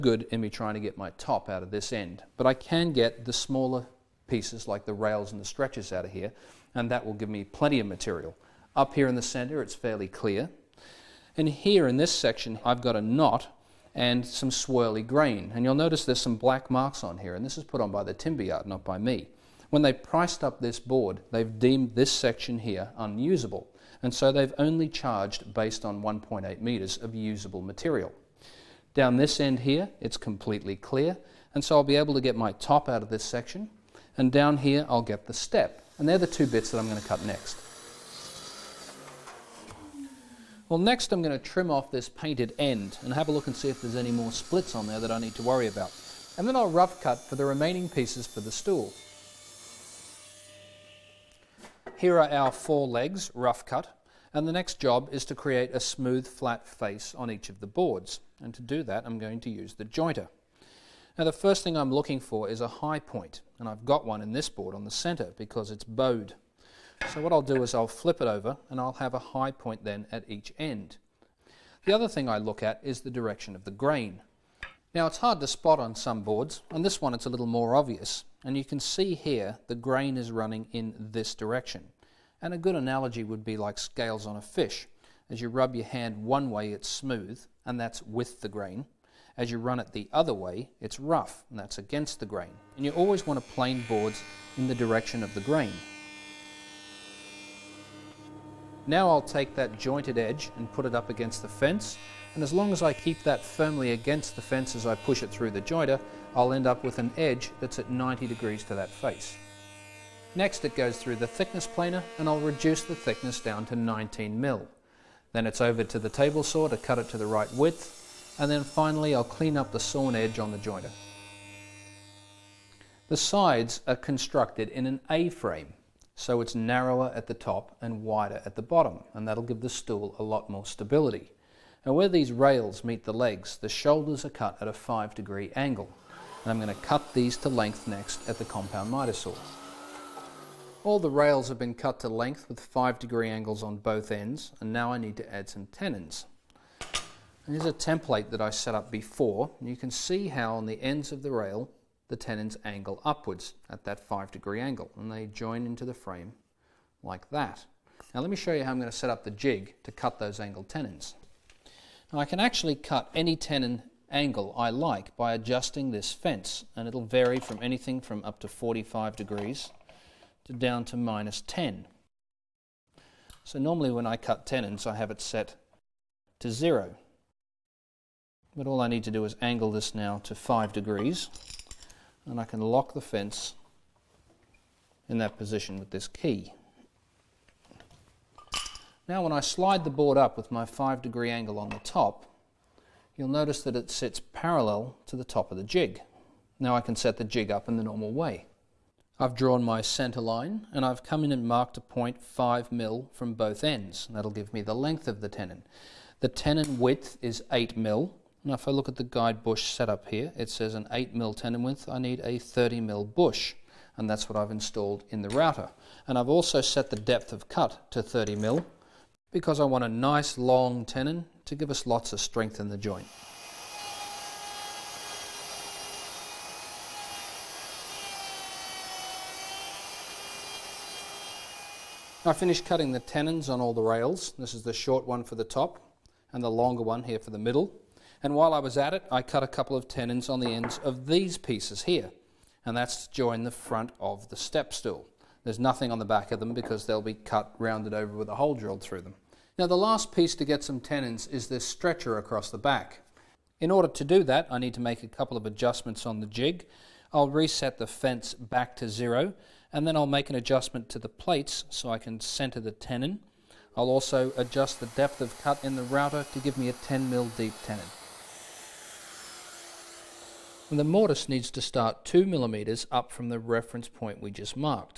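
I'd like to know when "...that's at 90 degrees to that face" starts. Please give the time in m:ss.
1:47.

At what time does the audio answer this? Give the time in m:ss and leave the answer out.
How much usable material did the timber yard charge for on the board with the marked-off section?
0:26.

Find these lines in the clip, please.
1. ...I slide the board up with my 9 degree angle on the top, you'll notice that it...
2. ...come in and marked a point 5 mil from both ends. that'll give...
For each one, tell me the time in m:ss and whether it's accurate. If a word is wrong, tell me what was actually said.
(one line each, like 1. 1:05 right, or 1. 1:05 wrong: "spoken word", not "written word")
1. 3:09 wrong: "5", not "9"
2. 3:21 right.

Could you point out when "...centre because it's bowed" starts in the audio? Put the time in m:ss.
1:04.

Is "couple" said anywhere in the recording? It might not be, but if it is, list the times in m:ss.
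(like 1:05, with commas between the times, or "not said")
3:59, 4:15.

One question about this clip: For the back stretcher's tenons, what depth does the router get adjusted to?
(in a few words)
10 mm.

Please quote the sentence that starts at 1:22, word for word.
And a good analogy would be like scales on a fish.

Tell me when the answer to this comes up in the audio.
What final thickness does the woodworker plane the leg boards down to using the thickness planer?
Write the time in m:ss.
1:53.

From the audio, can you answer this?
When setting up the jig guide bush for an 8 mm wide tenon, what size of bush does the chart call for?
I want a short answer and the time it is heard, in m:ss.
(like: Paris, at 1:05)
30 mm, at 3:32.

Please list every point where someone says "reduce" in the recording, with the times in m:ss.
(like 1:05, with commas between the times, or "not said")
1:52.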